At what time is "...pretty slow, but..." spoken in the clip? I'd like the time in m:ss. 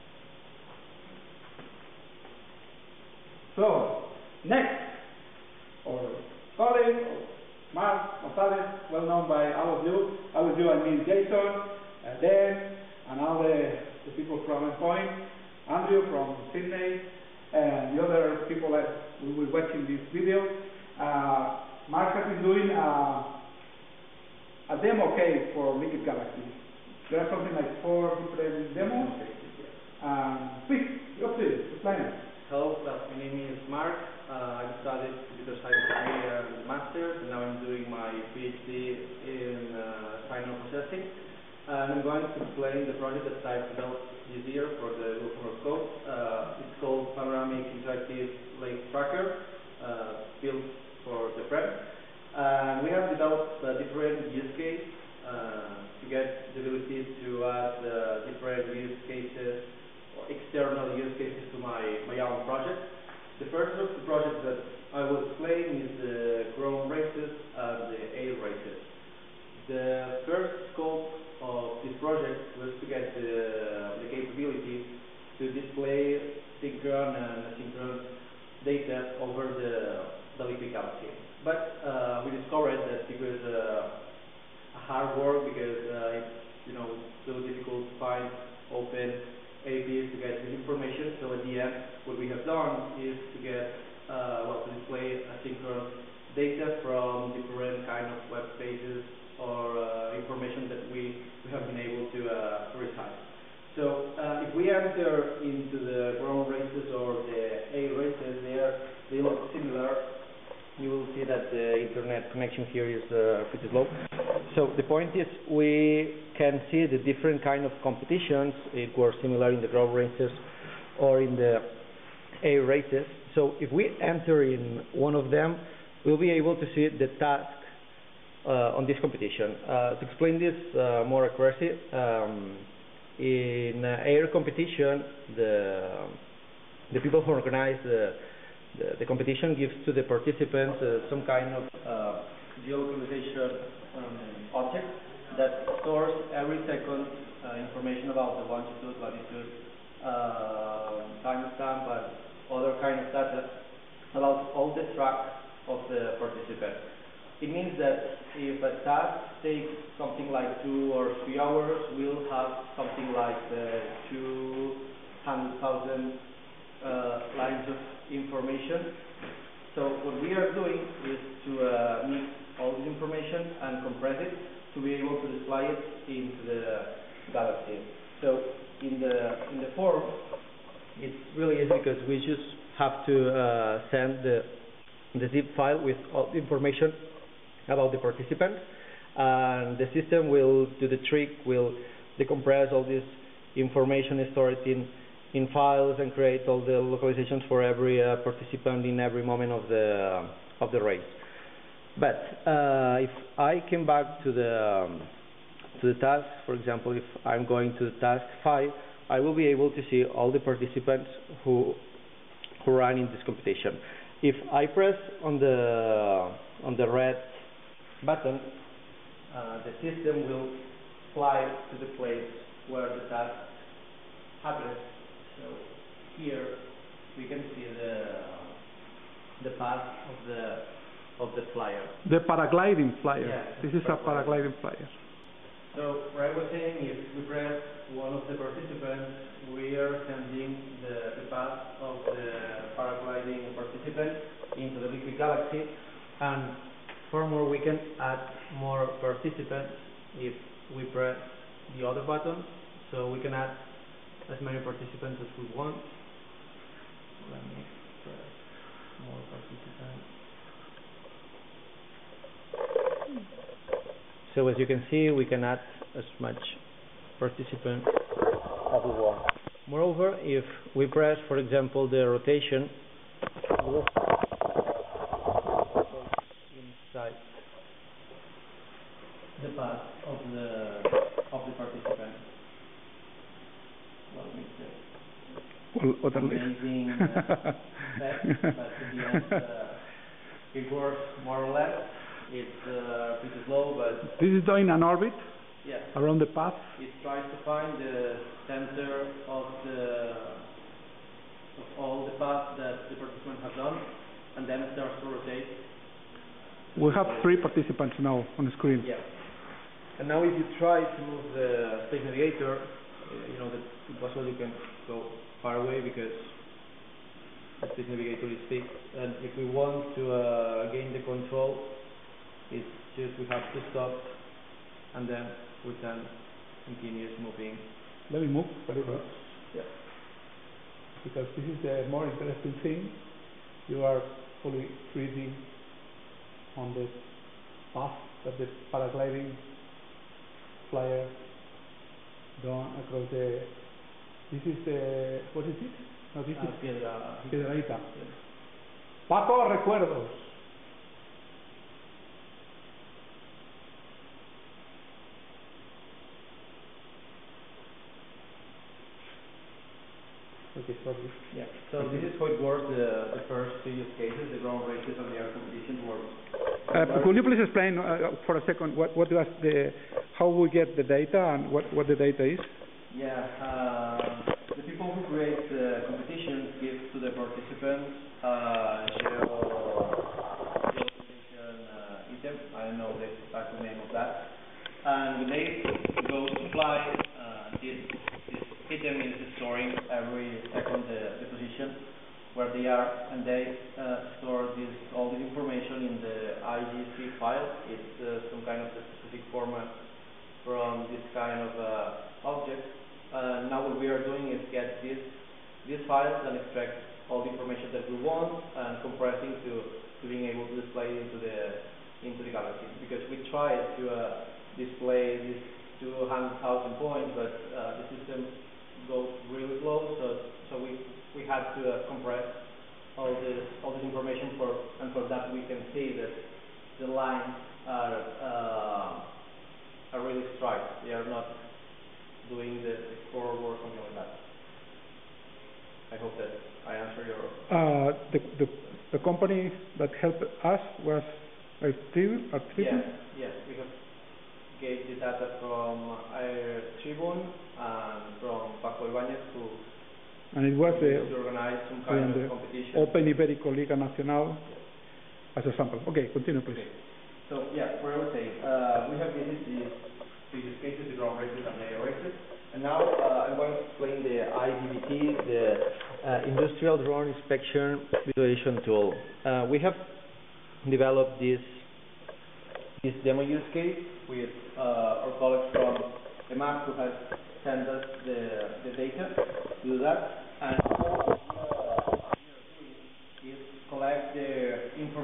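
4:53.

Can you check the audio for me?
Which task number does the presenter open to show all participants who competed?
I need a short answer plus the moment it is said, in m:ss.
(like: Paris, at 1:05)
Task 5, at 3:28.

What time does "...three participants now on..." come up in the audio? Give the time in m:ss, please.
5:07.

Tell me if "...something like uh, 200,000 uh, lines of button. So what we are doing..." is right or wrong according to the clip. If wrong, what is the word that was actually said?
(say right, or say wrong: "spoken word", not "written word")
wrong: "information", not "button".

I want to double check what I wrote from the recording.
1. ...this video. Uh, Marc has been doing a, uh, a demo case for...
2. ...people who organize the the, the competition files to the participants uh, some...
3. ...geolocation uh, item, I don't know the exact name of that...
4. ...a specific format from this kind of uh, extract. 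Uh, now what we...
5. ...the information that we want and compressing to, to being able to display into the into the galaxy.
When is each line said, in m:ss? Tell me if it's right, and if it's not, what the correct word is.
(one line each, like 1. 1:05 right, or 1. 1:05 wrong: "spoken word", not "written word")
1. 0:19 right
2. 2:17 wrong: "gives", not "files"
3. 6:20 right
4. 6:38 wrong: "object", not "extract"
5. 6:47 right.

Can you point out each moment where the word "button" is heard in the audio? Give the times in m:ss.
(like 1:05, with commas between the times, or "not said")
3:38, 4:12.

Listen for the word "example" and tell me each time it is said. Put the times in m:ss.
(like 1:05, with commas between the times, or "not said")
3:26, 4:31.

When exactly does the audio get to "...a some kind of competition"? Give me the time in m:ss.
7:30.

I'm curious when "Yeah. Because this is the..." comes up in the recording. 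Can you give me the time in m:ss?
5:29.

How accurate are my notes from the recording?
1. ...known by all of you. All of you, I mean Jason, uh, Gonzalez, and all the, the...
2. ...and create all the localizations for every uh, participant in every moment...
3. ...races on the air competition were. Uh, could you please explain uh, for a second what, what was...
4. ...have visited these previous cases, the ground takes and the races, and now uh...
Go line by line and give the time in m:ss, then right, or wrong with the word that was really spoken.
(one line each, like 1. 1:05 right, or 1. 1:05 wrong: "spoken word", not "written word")
1. 0:09 wrong: "Dan", not "Gonzalez"
2. 3:16 right
3. 6:04 right
4. 7:39 wrong: "races", not "takes".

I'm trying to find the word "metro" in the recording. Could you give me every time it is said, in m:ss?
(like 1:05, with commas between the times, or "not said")
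not said.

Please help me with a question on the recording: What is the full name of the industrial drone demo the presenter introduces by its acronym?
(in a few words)
Industrial Drone Inspection Visualization Tool.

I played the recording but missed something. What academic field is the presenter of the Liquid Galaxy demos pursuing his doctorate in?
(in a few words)
Signal processing.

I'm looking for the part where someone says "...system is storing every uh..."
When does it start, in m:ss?
6:28.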